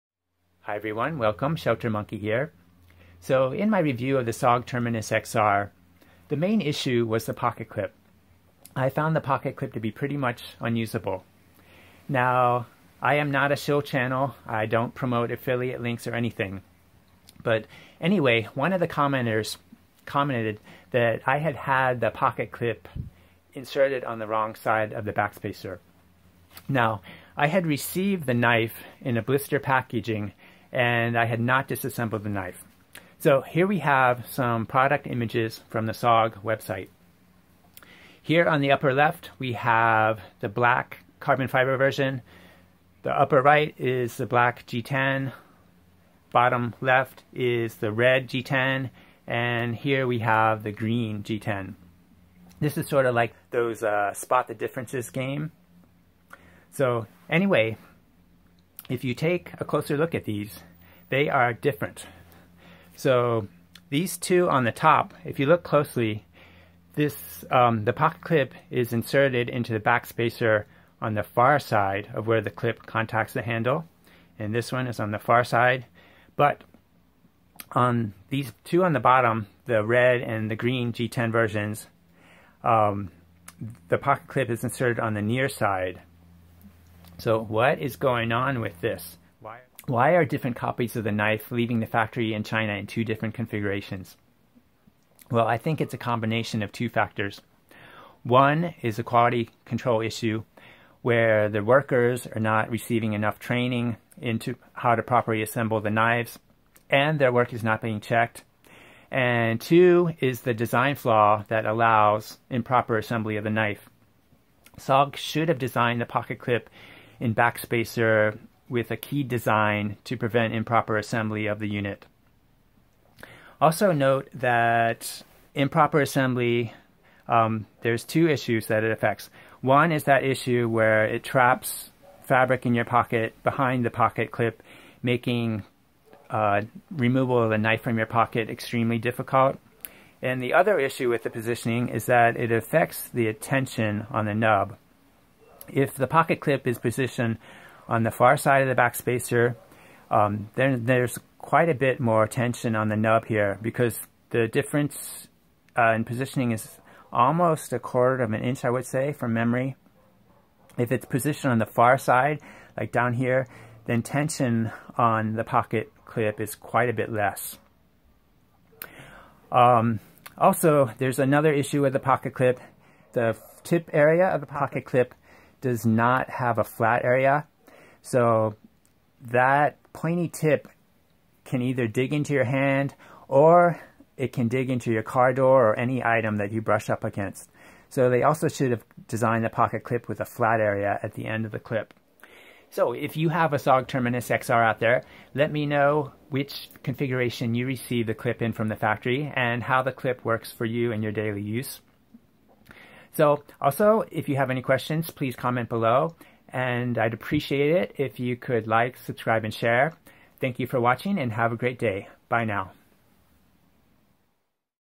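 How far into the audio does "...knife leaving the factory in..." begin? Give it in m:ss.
1:31.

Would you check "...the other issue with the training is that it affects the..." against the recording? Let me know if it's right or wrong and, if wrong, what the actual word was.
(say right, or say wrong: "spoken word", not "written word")
wrong: "positioning", not "training".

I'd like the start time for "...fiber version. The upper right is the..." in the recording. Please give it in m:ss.
0:41.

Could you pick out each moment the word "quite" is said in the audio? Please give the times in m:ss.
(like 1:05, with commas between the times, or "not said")
2:31, 2:46.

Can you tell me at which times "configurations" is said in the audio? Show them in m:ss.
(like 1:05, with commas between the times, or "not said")
1:33, 3:16.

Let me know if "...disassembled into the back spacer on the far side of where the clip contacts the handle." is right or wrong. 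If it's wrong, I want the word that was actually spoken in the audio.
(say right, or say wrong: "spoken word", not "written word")
wrong: "inserted", not "disassembled".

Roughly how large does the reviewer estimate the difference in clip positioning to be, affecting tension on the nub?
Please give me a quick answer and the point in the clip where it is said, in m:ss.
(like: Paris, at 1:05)
A quarter of an inch, at 2:37.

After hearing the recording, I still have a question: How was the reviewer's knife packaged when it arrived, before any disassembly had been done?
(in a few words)
Blister packaging.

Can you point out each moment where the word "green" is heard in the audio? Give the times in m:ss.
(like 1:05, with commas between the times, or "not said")
0:50, 1:20.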